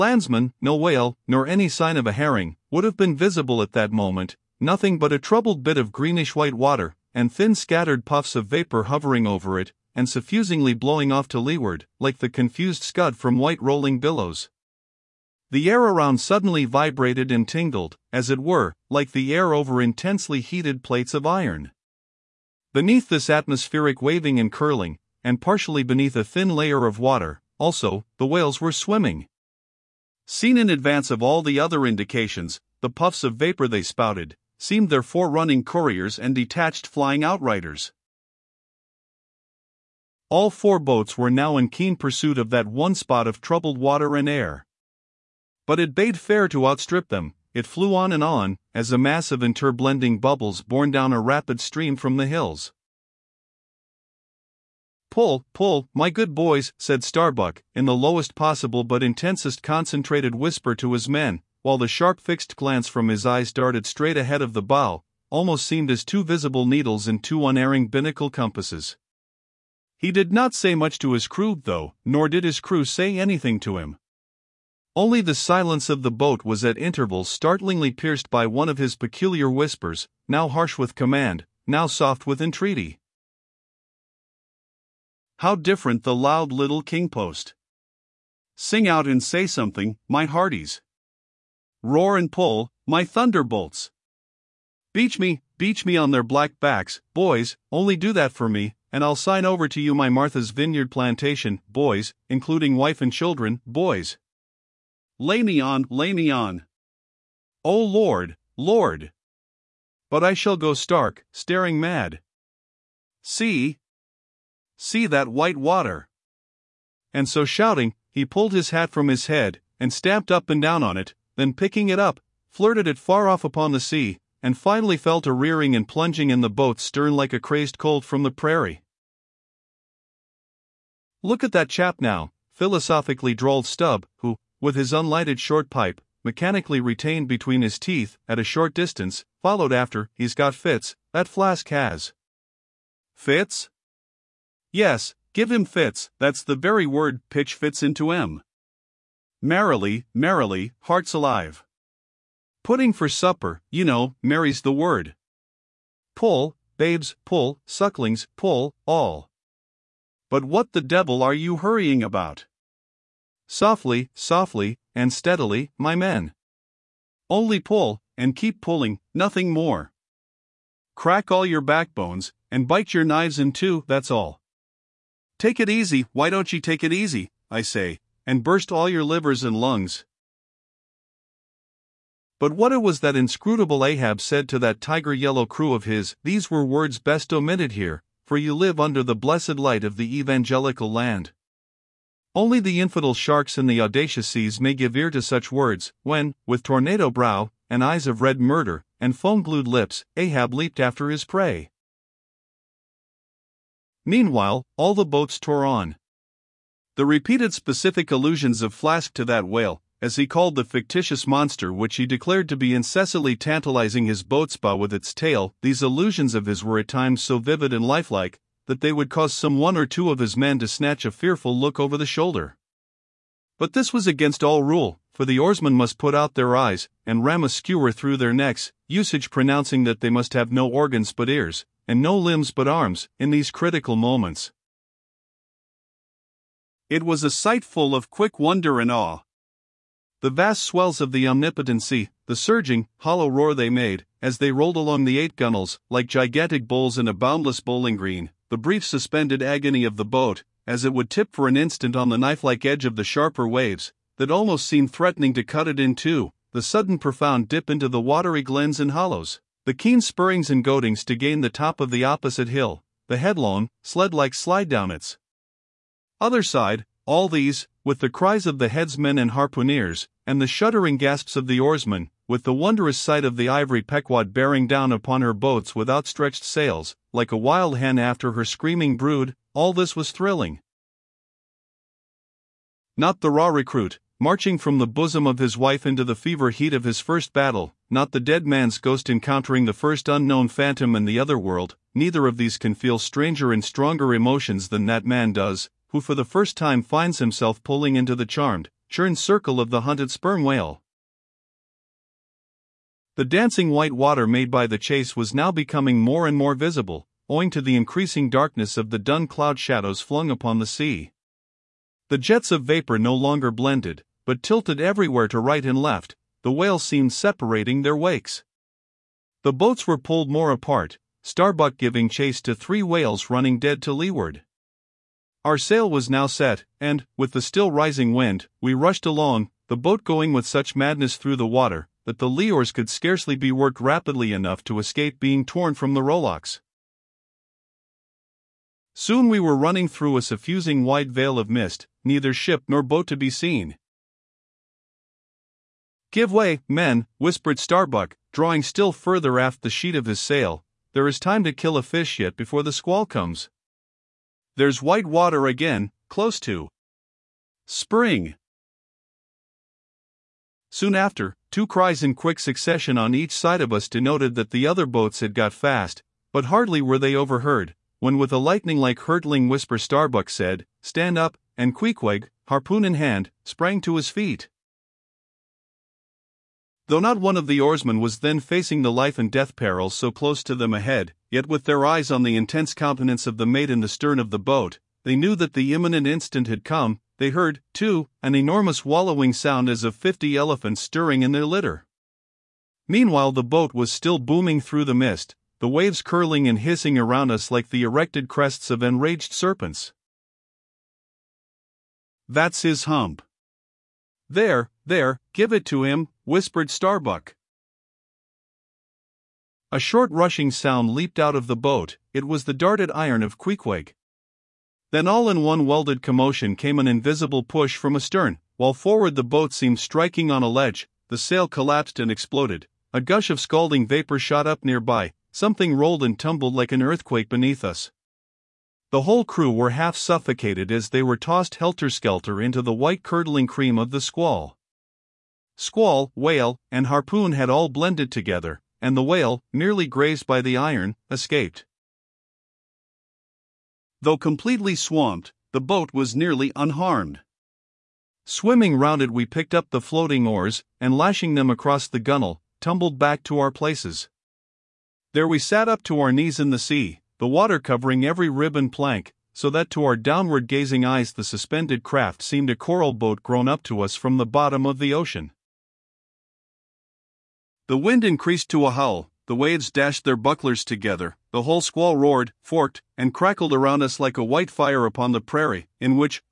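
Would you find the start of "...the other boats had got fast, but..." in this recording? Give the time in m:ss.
6:04.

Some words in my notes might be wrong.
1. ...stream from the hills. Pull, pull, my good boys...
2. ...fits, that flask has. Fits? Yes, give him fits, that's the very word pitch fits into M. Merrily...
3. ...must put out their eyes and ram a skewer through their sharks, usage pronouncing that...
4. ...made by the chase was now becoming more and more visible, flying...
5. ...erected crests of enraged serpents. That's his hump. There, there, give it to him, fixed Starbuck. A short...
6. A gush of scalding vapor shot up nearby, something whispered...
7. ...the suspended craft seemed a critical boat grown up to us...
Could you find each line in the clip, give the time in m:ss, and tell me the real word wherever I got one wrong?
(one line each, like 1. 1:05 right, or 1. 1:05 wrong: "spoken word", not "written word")
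1. 0:51 right
2. 2:20 right
3. 3:45 wrong: "necks", not "sharks"
4. 5:04 wrong: "owing", not "flying"
5. 6:37 wrong: "whispered", not "fixed"
6. 7:02 wrong: "rolled", not "whispered"
7. 7:41 wrong: "coral", not "critical".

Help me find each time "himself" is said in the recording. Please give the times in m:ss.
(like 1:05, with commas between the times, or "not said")
4:57.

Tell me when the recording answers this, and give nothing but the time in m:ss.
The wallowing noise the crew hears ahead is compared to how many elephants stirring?
6:29.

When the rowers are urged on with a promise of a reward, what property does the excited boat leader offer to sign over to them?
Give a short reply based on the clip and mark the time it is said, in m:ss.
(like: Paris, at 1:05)
Martha's Vineyard plantation, at 1:40.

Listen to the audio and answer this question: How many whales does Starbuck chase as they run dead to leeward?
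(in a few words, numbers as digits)
3.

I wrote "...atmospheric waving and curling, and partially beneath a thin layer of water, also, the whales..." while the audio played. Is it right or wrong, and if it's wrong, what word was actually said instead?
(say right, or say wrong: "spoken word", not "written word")
right.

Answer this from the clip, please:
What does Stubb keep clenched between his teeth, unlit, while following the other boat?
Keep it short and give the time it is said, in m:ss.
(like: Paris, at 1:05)
short pipe, at 2:15.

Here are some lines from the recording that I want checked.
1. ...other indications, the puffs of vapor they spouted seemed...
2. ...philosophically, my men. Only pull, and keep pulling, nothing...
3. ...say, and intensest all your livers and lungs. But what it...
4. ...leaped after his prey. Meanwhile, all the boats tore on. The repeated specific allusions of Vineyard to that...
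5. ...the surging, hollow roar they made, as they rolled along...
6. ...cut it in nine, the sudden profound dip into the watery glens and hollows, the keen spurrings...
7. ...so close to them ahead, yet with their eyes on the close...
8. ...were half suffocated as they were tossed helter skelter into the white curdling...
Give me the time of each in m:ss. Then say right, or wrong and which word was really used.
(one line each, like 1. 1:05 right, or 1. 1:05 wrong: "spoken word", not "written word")
1. 0:31 right
2. 2:45 wrong: "steadily", not "philosophically"
3. 2:57 wrong: "burst", not "intensest"
4. 3:20 wrong: "Flask", not "Vineyard"
5. 4:02 right
6. 4:15 wrong: "two", not "nine"
7. 6:19 wrong: "intense", not "close"
8. 7:09 right.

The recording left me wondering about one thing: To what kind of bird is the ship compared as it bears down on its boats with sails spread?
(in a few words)
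wild hen.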